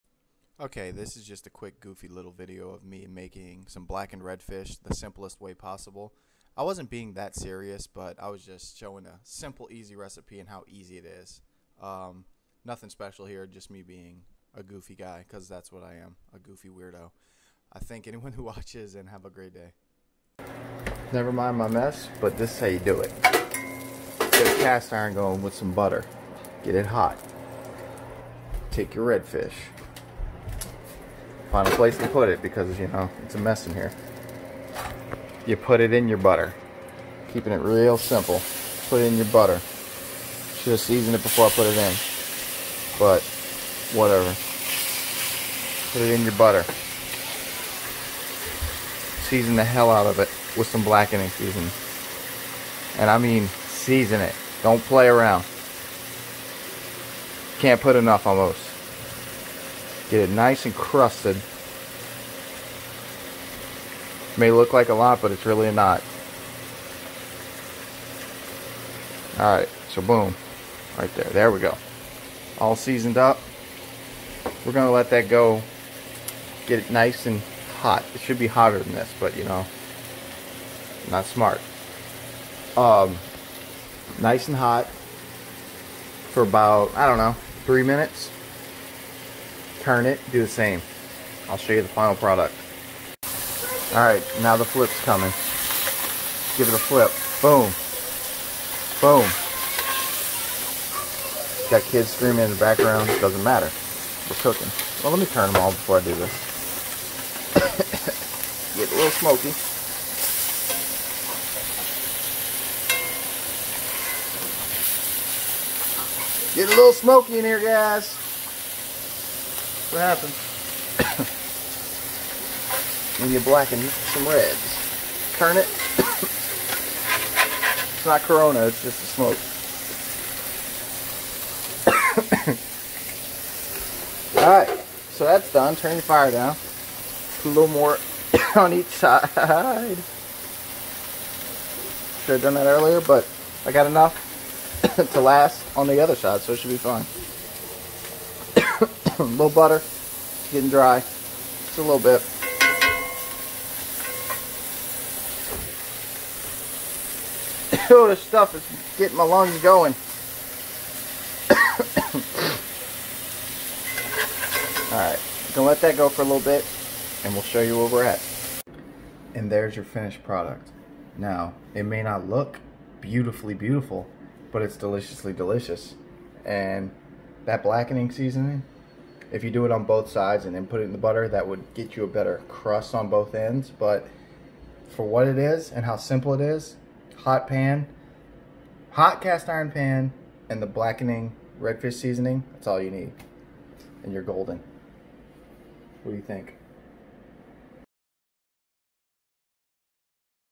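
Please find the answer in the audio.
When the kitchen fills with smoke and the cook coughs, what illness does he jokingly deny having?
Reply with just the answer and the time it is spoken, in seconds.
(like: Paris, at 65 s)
Corona, at 128 s.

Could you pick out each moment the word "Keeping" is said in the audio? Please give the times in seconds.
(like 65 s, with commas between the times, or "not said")
37 s.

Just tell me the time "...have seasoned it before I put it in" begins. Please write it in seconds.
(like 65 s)
40 s.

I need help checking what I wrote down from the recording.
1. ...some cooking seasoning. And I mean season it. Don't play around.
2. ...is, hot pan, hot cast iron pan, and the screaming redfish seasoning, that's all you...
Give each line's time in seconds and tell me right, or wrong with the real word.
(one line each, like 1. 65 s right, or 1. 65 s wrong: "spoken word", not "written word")
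1. 50 s wrong: "blackening", not "cooking"
2. 186 s wrong: "blackening", not "screaming".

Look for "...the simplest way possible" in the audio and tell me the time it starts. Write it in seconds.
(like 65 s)
4 s.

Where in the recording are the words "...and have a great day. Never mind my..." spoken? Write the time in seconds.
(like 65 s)
18 s.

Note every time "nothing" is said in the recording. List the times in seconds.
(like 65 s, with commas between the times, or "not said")
12 s.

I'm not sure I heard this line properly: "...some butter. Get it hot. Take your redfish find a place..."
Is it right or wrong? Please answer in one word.
right.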